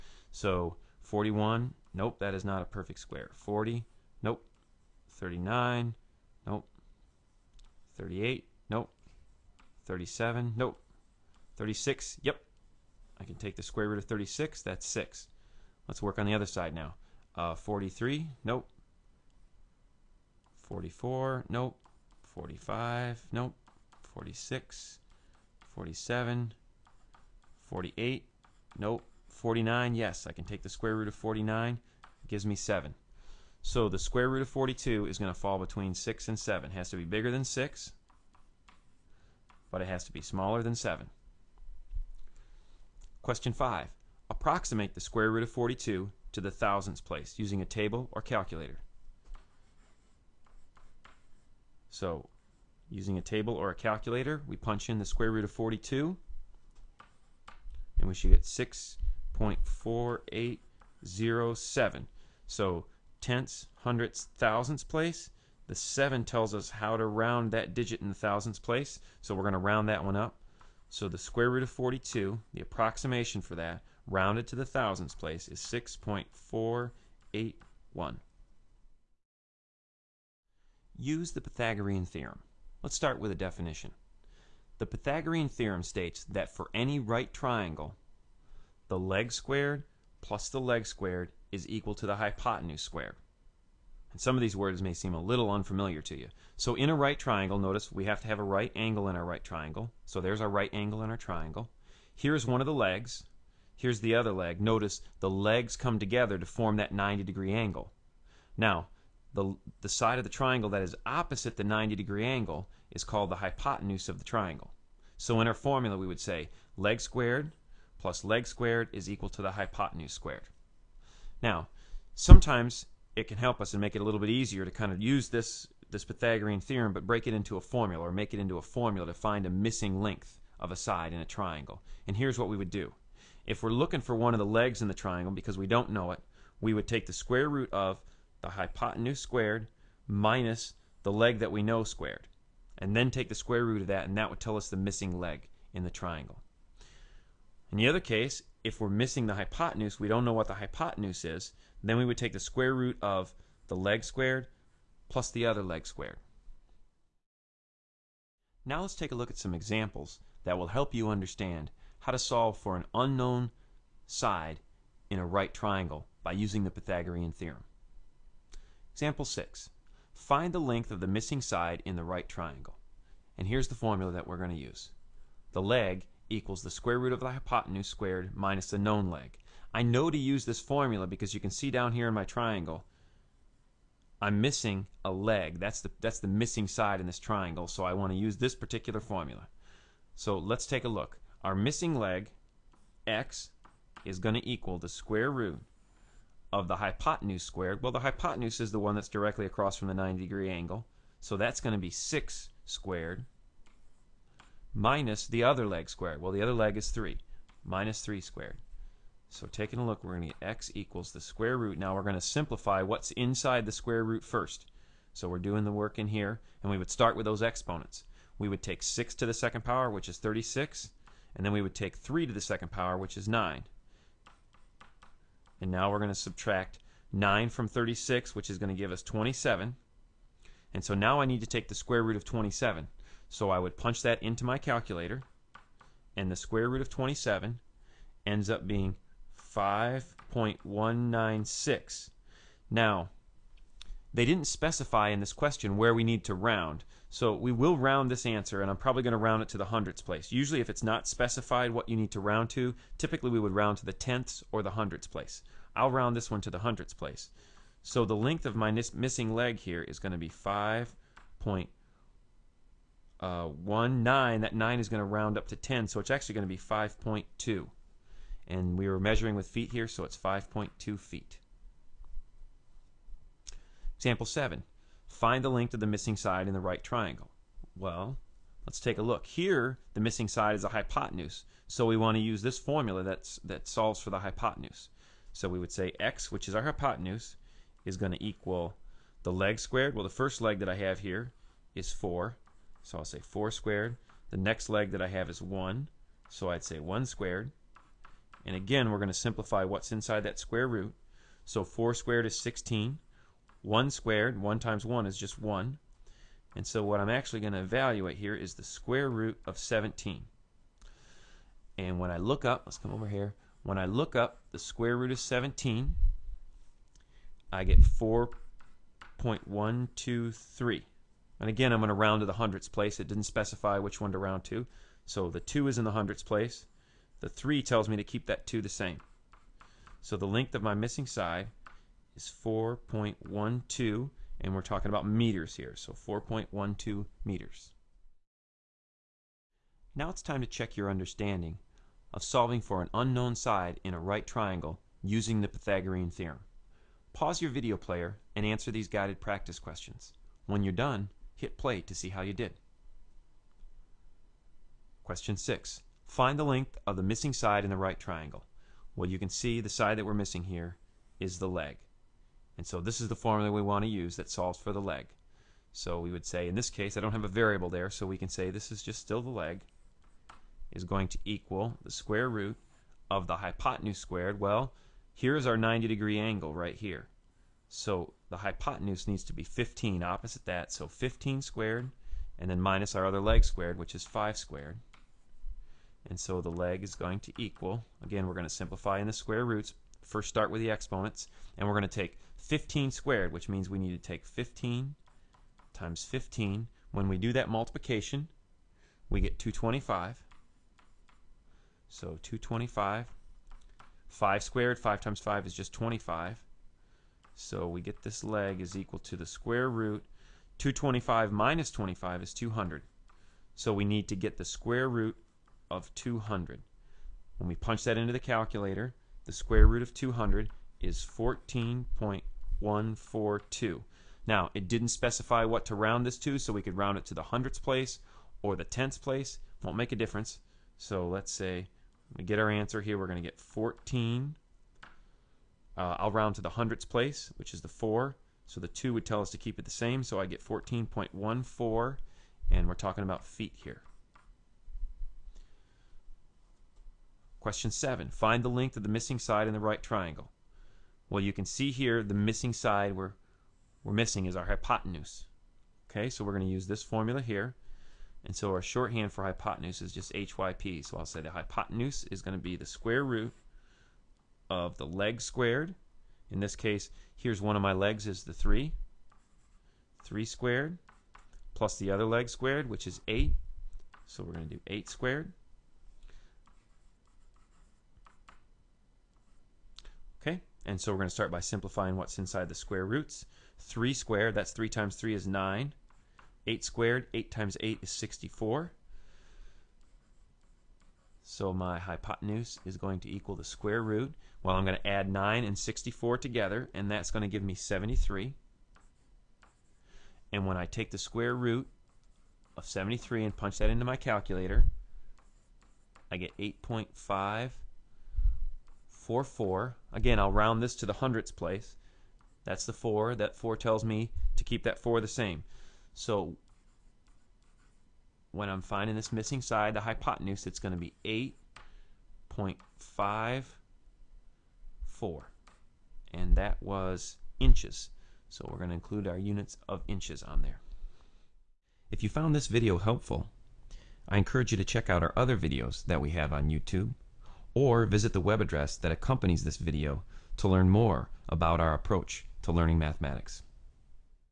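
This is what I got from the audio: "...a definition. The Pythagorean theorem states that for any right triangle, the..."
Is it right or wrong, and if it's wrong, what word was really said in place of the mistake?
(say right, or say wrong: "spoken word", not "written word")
right.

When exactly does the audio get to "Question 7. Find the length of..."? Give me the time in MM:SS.
07:27.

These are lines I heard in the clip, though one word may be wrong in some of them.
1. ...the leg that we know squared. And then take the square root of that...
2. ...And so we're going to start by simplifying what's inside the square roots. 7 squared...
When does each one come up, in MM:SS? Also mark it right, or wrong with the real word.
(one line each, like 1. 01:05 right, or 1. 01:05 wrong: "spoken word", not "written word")
1. 02:21 right
2. 08:00 wrong: "3", not "7".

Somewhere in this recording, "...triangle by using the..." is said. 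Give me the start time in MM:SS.
02:45.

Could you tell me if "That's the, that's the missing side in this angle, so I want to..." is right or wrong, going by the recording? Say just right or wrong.
wrong.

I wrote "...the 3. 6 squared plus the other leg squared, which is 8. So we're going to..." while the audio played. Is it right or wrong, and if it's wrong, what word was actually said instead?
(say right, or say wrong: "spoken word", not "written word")
wrong: "3", not "6".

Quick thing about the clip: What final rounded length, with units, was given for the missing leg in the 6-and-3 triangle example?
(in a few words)
5.2 feet.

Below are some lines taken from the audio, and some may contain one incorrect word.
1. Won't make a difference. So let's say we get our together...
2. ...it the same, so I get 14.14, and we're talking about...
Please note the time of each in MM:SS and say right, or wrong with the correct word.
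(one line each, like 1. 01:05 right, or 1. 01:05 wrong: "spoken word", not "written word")
1. 07:09 wrong: "answer", not "together"
2. 07:19 right.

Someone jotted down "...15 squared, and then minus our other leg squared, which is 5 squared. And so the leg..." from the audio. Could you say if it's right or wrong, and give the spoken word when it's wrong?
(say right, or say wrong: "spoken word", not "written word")
right.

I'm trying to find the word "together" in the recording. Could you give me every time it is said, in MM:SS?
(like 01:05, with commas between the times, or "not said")
01:45, 08:16.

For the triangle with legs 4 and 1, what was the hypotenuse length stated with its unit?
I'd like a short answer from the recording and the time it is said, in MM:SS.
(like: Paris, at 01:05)
4.12 meters, at 05:35.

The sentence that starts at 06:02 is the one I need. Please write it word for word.
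And so this is the formula we want to use that solves for the leg.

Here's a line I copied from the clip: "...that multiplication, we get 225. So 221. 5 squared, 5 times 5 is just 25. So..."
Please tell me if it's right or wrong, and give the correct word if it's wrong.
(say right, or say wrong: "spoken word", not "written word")
wrong: "225", not "221".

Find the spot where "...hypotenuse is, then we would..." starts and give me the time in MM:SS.
02:30.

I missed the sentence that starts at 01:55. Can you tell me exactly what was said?
So in our formula, we would say leg squared plus leg squared is equal to the hypotenuse squared.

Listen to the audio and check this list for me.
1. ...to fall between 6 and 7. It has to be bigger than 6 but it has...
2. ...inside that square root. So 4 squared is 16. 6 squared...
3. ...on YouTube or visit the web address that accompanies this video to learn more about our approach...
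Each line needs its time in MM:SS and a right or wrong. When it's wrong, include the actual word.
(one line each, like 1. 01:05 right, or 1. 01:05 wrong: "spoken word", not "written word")
1. 00:35 right
2. 04:59 wrong: "1", not "6"
3. 08:56 right.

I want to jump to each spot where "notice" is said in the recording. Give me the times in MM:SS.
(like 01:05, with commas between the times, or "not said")
01:37, 01:44.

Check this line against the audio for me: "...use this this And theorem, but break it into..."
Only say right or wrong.
wrong.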